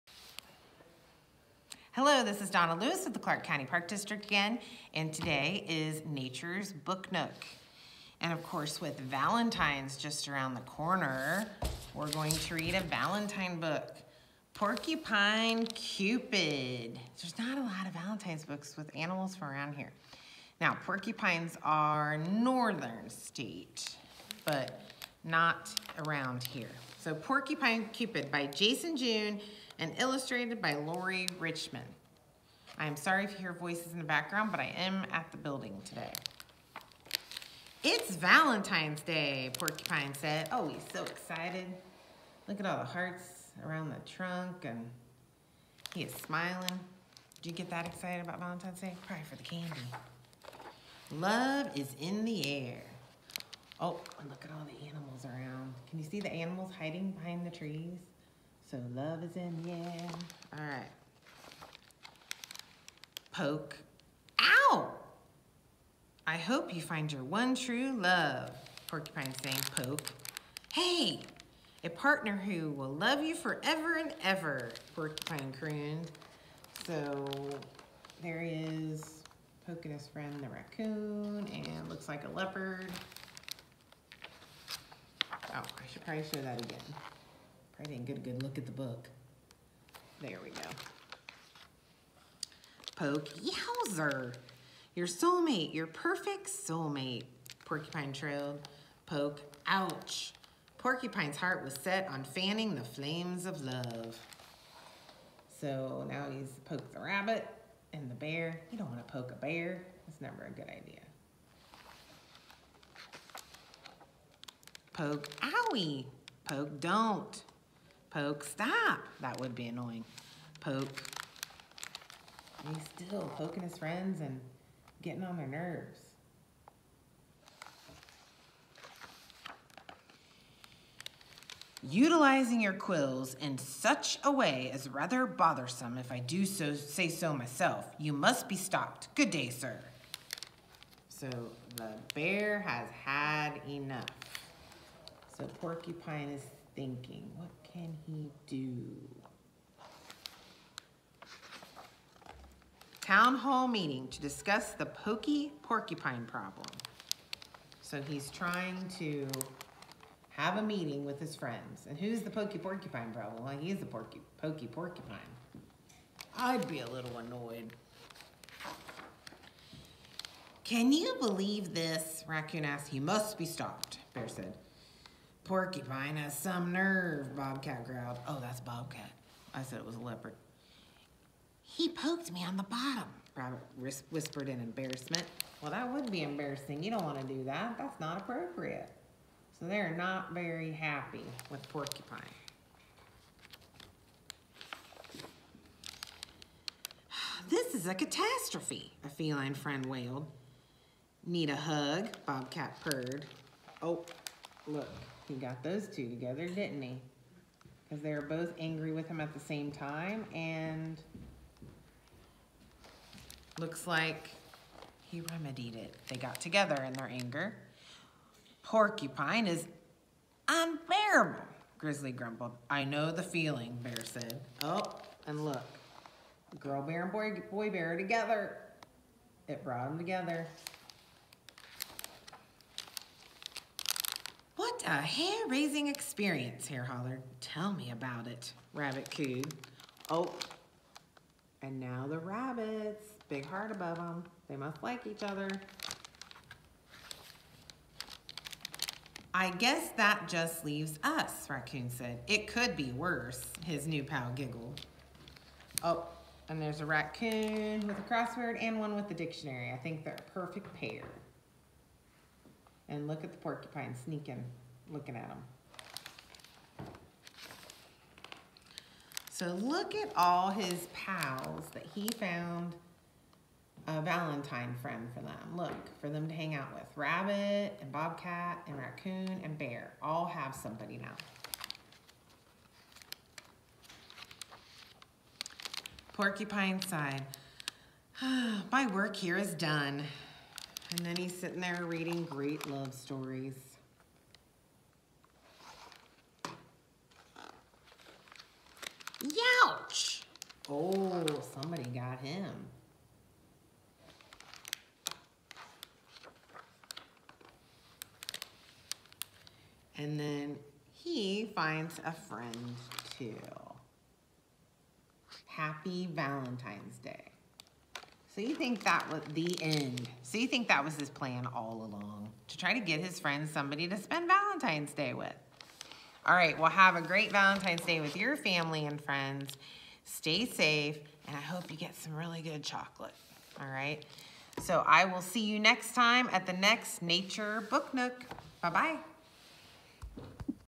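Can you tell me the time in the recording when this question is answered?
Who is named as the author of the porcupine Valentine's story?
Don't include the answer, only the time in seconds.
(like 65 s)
28 s.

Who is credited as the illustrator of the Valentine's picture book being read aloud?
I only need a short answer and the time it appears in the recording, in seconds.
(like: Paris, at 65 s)
Lori Richmond, at 30 s.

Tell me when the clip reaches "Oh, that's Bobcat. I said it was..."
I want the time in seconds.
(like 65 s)
178 s.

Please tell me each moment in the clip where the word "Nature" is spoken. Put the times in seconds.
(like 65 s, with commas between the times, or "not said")
6 s, 337 s.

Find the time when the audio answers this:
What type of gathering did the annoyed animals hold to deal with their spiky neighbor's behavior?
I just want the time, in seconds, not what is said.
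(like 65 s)
153 s.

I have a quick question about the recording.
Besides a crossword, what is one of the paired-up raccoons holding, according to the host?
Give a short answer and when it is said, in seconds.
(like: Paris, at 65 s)
A dictionary, at 259 s.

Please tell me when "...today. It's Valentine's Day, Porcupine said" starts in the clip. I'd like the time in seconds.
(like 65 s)
35 s.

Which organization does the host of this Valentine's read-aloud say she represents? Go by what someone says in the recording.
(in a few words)
Clark County Park District.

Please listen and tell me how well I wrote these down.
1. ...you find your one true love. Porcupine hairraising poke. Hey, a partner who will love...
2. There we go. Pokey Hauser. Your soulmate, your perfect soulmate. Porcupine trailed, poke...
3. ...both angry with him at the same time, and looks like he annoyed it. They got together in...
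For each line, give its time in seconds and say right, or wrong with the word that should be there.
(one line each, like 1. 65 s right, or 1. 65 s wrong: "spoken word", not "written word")
1. 66 s wrong: "saying", not "hairraising"
2. 90 s right
3. 208 s wrong: "remedied", not "annoyed".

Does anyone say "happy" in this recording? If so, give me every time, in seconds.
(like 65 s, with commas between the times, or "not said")
190 s, 315 s.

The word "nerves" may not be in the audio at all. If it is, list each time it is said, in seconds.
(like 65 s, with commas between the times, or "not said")
125 s, 176 s.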